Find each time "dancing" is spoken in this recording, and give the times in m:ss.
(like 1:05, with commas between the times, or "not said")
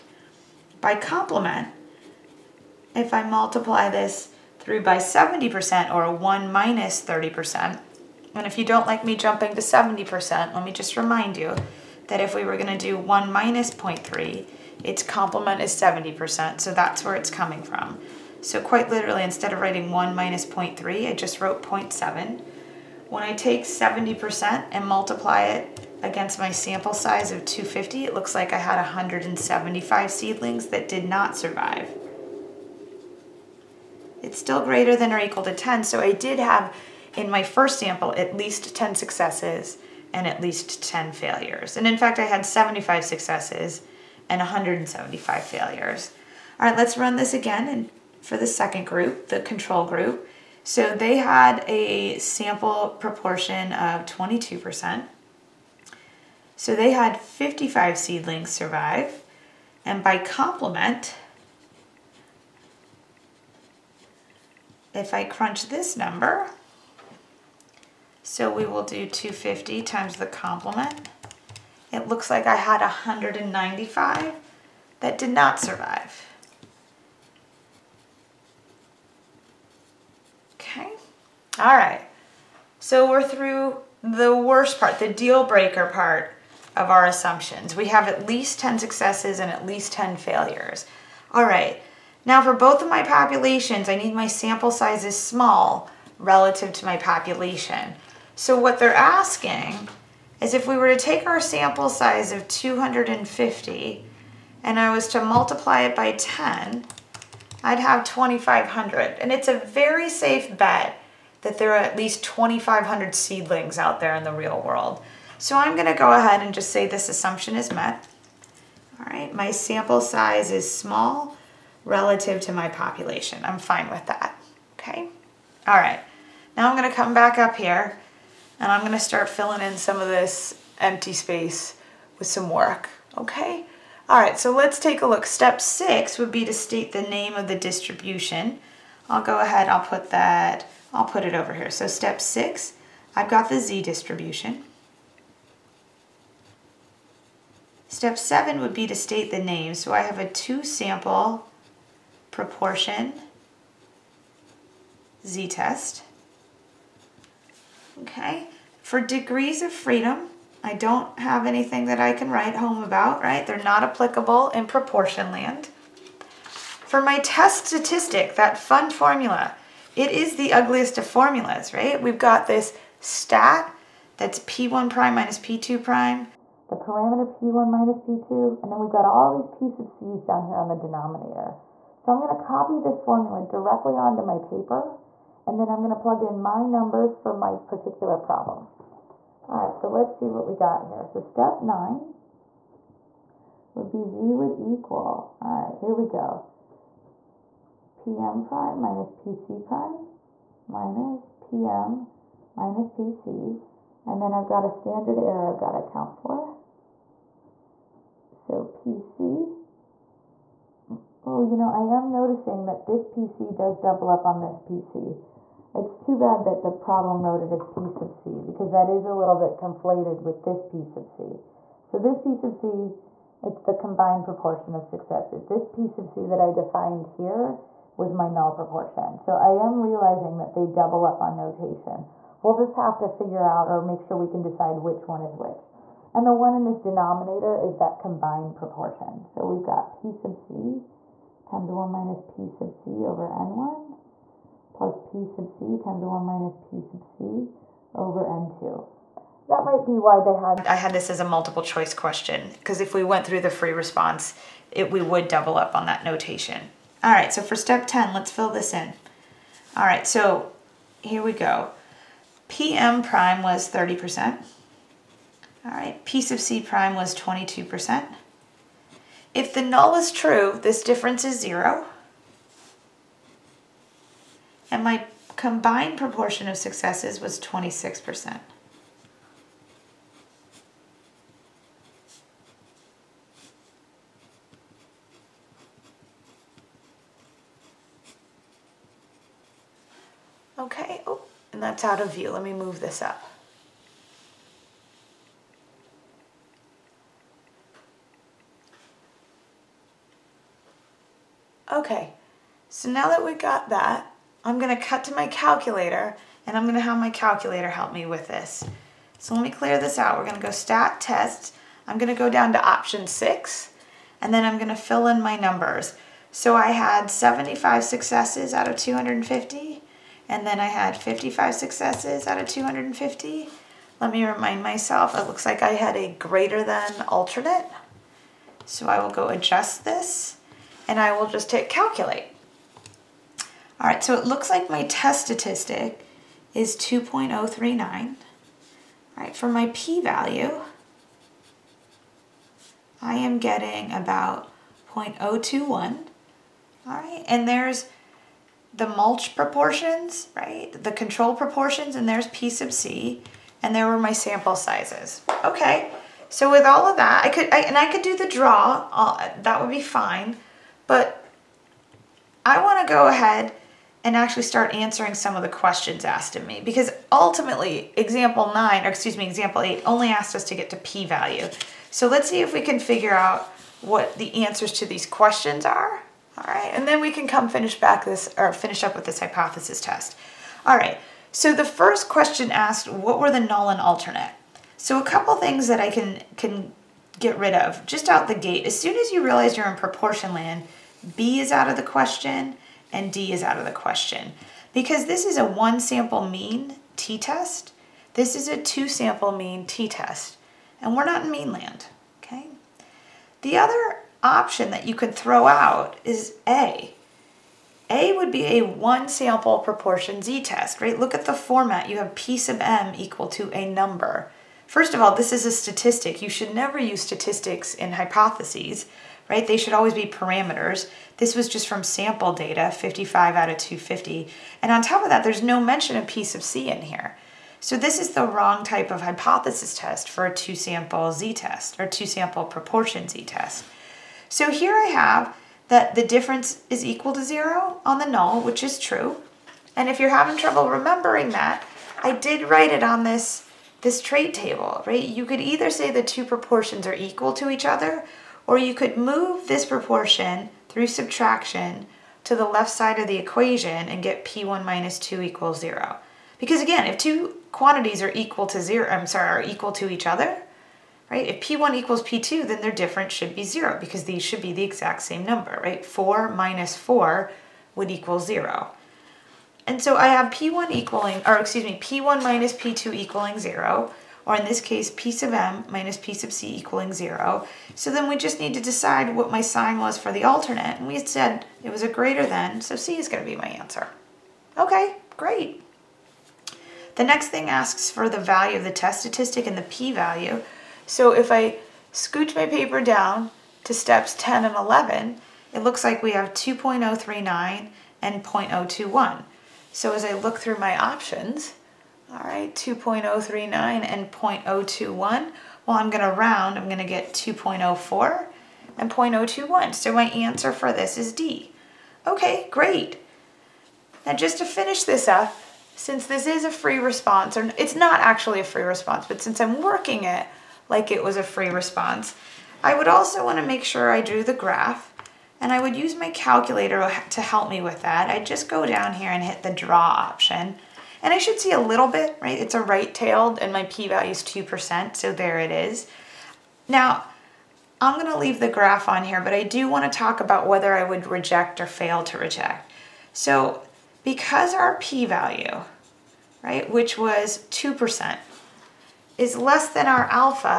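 not said.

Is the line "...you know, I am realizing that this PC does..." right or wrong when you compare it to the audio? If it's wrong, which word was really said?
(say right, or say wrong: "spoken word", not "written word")
wrong: "noticing", not "realizing".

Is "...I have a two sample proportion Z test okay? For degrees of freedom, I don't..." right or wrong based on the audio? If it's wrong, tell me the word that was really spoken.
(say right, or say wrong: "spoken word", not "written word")
right.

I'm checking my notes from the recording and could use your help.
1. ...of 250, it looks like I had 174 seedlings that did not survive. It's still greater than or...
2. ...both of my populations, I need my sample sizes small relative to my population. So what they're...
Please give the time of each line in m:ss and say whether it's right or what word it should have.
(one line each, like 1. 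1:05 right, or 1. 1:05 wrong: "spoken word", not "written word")
1. 0:27 wrong: "175", not "174"
2. 1:32 right.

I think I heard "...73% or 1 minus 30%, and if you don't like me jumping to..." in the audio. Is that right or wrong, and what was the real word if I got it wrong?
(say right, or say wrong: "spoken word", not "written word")
wrong: "70", not "73".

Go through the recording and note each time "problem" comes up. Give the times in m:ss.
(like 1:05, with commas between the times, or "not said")
3:08, 3:36.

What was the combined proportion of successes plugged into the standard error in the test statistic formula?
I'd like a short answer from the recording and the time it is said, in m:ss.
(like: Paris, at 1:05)
26%, at 4:37.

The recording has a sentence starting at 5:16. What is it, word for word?
So I had 75 successes out of 250 and then I had 55 successes out of 250.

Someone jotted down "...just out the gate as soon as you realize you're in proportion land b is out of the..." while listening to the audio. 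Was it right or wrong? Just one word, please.
right.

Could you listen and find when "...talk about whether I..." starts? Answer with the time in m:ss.
8:59.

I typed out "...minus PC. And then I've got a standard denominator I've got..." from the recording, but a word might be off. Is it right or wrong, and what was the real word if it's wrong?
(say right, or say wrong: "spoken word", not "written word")
wrong: "error", not "denominator".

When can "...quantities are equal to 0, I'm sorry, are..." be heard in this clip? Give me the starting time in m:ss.
7:37.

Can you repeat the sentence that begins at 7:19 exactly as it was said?
And if you're having trouble remembering that, I did write it on this, this trait table, right?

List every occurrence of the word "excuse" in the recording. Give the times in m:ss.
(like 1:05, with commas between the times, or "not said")
6:08, 7:51.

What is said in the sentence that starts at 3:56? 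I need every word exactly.
And the one in this denominator is that combined proportion.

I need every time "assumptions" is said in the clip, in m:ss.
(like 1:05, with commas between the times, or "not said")
1:27, 1:57.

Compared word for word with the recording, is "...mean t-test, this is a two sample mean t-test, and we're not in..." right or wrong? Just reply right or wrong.
right.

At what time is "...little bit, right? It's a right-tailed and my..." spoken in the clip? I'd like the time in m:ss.
8:51.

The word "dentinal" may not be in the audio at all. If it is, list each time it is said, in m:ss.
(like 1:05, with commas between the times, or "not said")
not said.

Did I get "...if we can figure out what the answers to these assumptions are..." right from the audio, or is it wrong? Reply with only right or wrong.
wrong.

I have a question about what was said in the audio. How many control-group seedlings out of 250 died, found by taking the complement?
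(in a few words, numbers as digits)
195.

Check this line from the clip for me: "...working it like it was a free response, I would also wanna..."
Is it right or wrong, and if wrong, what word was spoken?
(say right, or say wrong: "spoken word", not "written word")
right.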